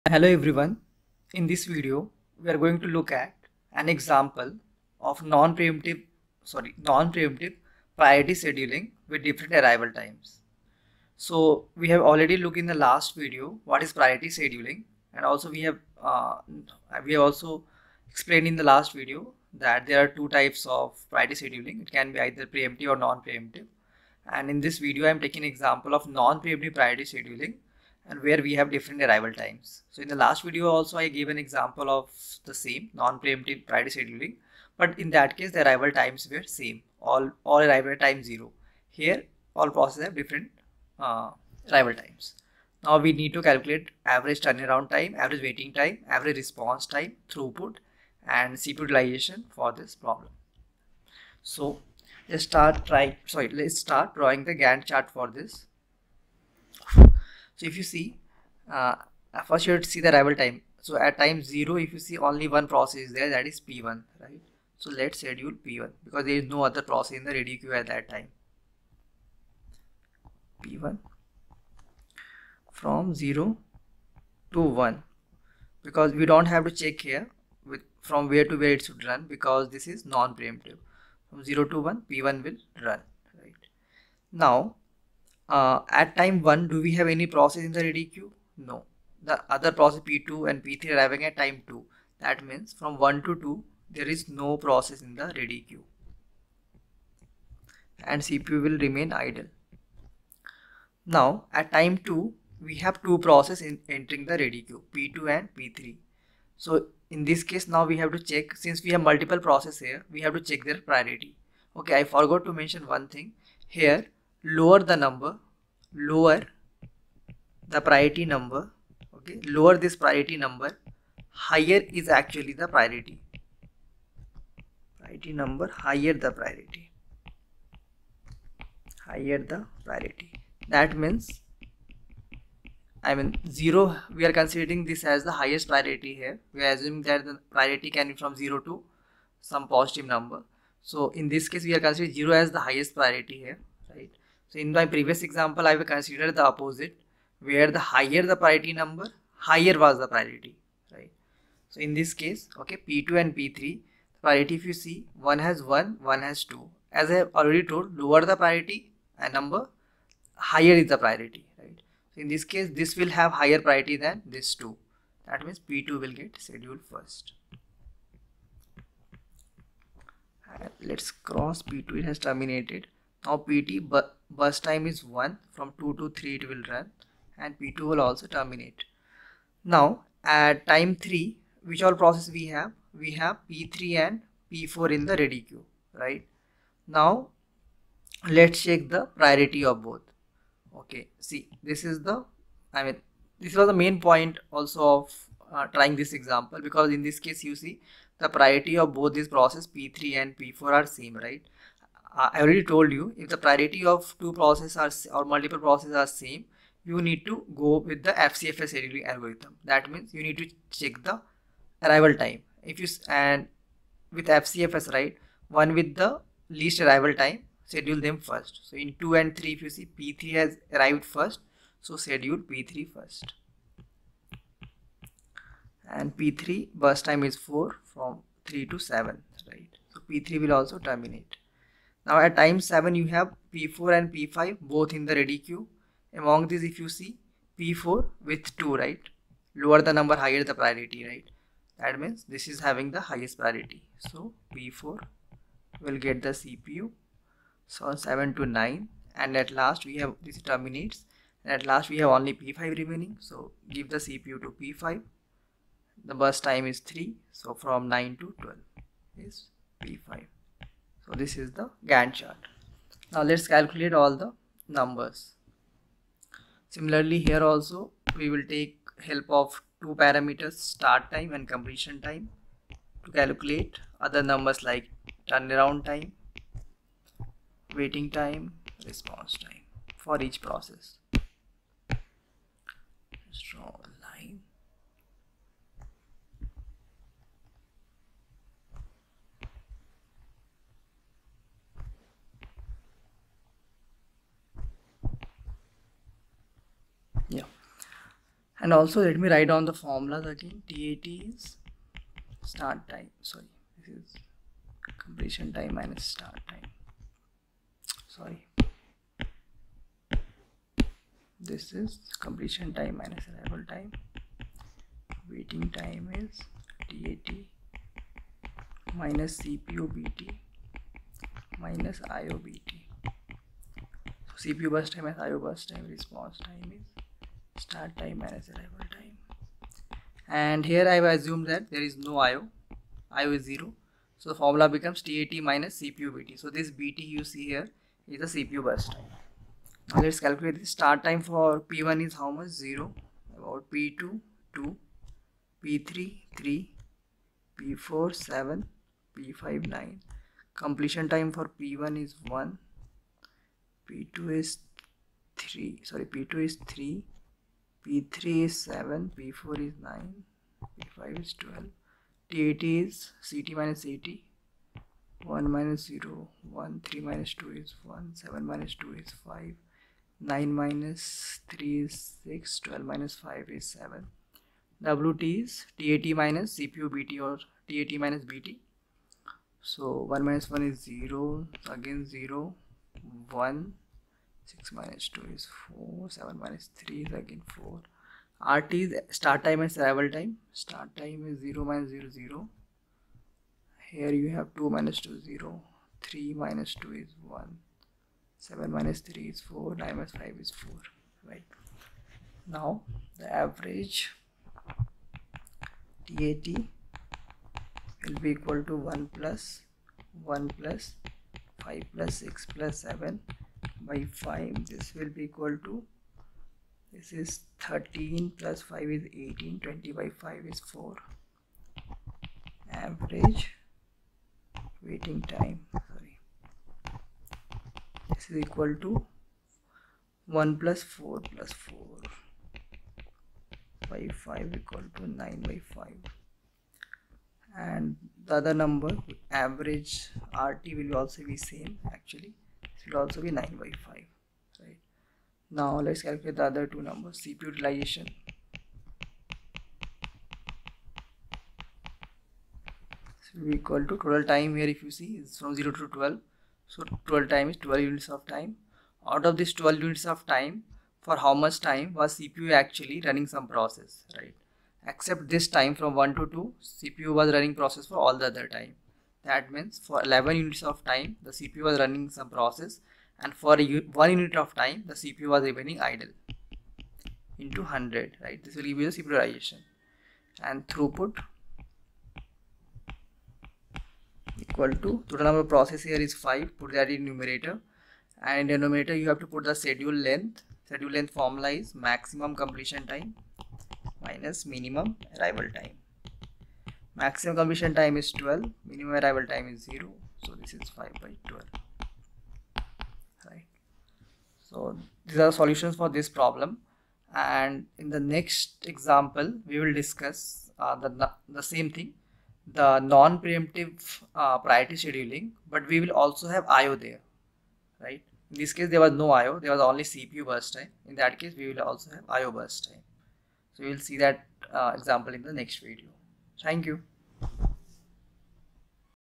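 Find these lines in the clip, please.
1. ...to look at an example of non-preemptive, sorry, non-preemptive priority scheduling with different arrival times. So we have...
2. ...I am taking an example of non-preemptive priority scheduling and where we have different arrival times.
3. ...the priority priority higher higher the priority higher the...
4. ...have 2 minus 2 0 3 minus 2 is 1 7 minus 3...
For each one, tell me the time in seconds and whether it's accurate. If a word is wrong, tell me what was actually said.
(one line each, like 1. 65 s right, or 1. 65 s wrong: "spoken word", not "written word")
1. 2 s right
2. 25 s right
3. 122 s wrong: "number", not "higher"
4. 394 s right.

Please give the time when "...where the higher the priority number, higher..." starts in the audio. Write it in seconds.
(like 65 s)
147 s.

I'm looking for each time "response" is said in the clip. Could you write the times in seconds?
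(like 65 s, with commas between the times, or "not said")
46 s, 278 s, 325 s.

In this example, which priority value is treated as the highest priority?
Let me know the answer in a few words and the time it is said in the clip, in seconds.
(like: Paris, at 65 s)
0, at 133 s.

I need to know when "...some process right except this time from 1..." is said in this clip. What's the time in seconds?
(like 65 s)
463 s.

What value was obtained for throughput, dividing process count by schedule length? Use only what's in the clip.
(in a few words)
5/12.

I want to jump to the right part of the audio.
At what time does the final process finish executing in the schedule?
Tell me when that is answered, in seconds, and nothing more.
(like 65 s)
257 s.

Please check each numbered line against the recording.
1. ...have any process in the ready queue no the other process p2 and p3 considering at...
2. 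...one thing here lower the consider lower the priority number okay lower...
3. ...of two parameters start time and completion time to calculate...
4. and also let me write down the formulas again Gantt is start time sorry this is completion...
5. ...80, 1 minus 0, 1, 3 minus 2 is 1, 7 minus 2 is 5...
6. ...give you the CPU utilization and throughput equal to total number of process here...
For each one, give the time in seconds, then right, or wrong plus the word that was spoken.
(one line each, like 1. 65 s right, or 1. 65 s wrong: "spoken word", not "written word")
1. 86 s wrong: "arriving", not "considering"
2. 112 s wrong: "number", not "consider"
3. 269 s right
4. 298 s wrong: "TAT", not "Gantt"
5. 363 s right
6. 478 s right.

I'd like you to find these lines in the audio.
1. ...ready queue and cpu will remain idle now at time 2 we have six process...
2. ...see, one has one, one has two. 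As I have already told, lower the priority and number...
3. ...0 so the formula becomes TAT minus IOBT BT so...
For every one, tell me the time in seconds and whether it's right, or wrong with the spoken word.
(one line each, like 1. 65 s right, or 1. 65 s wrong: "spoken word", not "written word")
1. 95 s wrong: "two", not "six"
2. 154 s right
3. 333 s wrong: "CPU", not "IOBT".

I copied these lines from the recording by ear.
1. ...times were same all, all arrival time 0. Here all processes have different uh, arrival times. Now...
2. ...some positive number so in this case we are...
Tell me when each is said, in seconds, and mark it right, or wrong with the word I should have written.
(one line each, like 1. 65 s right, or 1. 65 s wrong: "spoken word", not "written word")
1. 35 s right
2. 139 s right.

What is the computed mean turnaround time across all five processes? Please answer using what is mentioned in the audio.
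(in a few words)
4.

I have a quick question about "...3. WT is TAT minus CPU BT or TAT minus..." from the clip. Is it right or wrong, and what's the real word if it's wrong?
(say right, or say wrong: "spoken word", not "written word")
wrong: "7", not "3".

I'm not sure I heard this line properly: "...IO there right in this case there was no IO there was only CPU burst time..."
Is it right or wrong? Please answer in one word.
right.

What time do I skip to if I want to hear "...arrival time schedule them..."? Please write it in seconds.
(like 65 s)
216 s.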